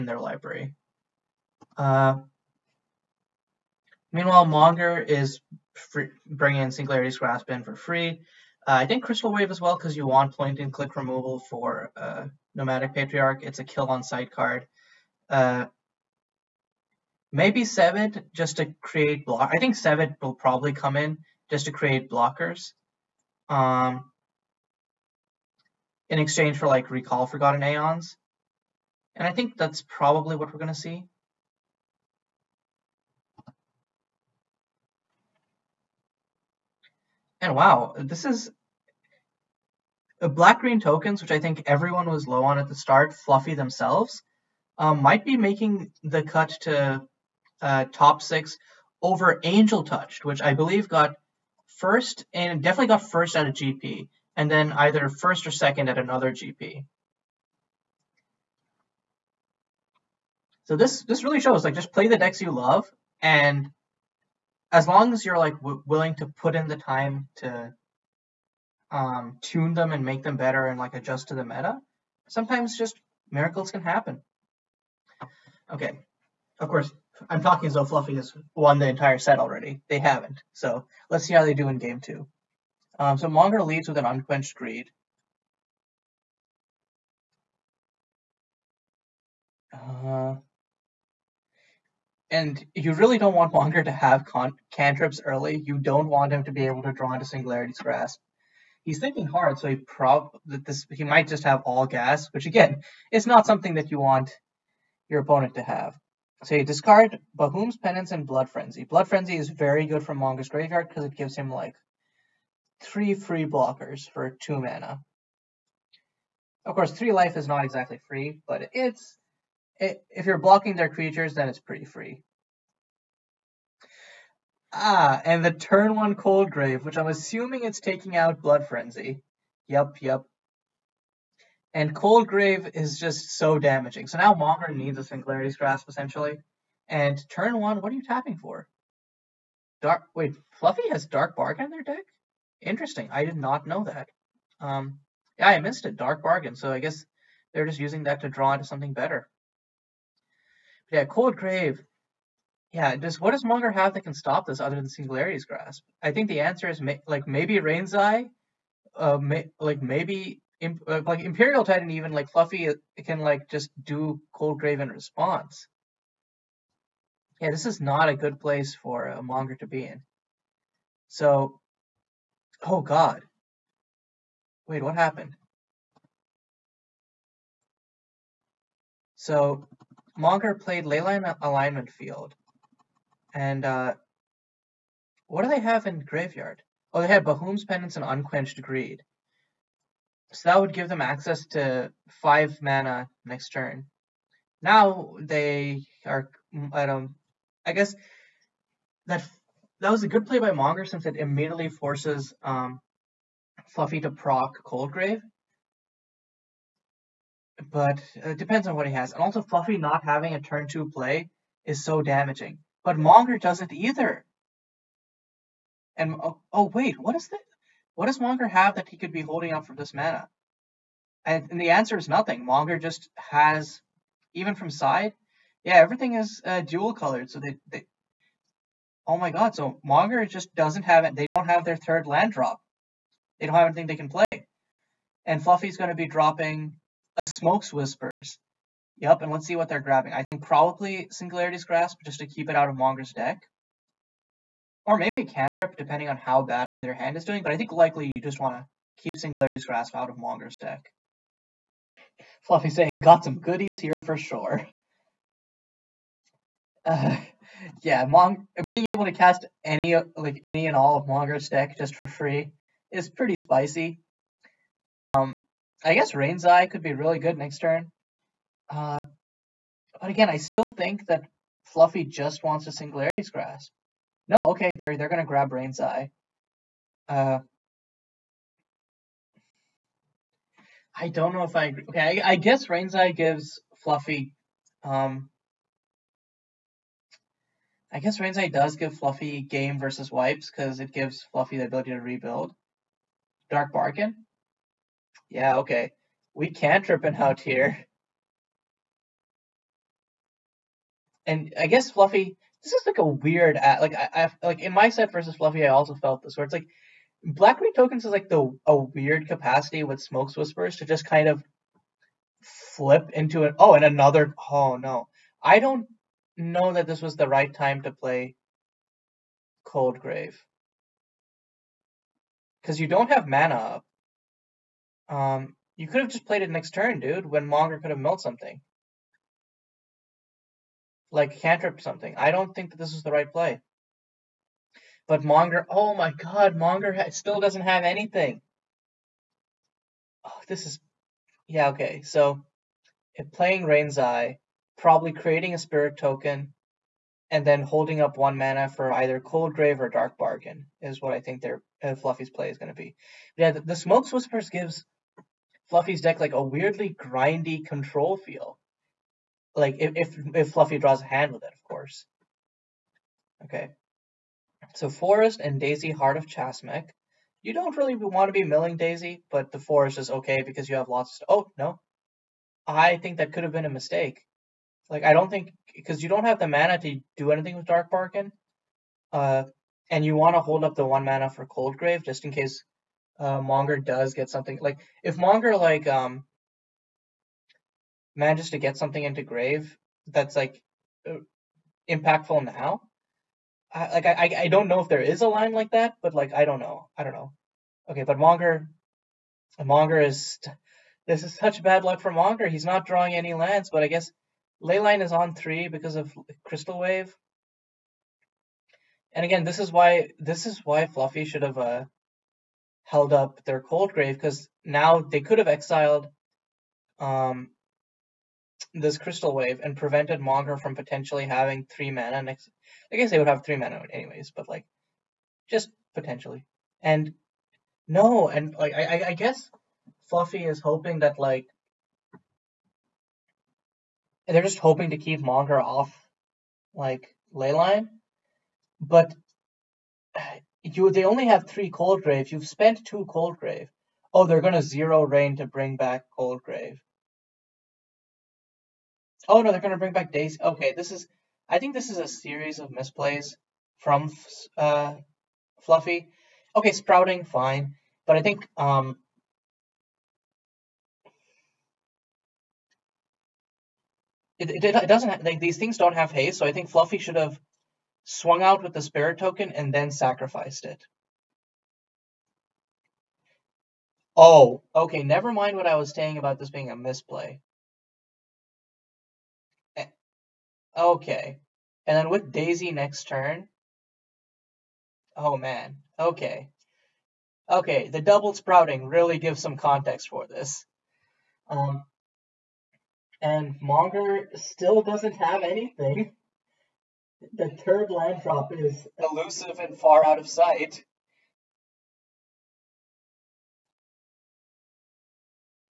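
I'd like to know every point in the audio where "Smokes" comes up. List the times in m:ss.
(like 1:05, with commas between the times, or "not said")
3:57, 5:10, 5:53.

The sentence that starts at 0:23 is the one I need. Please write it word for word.
Um, in exchange for like recall forgotten aeons.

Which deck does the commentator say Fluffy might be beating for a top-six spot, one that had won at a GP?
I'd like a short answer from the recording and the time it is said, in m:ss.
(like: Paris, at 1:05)
Angel Touched, at 0:49.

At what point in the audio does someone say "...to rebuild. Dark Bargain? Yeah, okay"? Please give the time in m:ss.
4:51.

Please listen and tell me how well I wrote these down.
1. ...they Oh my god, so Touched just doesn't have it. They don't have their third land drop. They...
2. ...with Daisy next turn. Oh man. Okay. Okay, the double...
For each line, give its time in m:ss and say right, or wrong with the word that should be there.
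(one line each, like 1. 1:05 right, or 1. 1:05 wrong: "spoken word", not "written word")
1. 3:47 wrong: "Monger", not "Touched"
2. 8:02 right.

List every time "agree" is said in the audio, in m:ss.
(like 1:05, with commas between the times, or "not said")
4:41.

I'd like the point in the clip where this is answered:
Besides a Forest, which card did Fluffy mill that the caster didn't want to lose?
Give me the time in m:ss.
6:05.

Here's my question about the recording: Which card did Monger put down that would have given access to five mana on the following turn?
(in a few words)
Leyline Alignment Field.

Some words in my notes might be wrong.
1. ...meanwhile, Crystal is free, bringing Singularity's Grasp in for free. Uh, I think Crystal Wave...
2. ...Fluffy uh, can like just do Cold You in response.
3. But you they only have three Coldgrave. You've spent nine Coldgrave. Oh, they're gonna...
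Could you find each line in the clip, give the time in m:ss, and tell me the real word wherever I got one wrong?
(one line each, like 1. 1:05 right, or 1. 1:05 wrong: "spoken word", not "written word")
1. 0:04 wrong: "Monger", not "Crystal"
2. 2:42 wrong: "Grave", not "You"
3. 7:18 wrong: "two", not "nine".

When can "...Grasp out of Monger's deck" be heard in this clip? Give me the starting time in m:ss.
4:09.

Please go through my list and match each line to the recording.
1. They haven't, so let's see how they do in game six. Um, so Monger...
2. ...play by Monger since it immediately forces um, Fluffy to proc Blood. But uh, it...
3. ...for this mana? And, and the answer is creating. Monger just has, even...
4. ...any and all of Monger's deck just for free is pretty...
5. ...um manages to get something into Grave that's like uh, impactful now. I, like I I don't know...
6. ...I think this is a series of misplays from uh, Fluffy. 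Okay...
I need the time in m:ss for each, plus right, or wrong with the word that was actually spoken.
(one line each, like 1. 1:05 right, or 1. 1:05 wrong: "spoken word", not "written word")
1. 1:19 wrong: "two", not "six"
2. 3:20 wrong: "Coldgrave", not "Blood"
3. 3:39 wrong: "nothing", not "creating"
4. 4:20 right
5. 6:25 right
6. 7:31 right.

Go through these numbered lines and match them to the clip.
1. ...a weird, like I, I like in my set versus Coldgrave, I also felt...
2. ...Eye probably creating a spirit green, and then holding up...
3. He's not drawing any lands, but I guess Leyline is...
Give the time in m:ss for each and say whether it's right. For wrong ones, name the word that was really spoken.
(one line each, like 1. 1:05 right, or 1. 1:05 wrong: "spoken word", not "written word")
1. 5:02 wrong: "Fluffy", not "Coldgrave"
2. 5:43 wrong: "token", not "green"
3. 6:42 right.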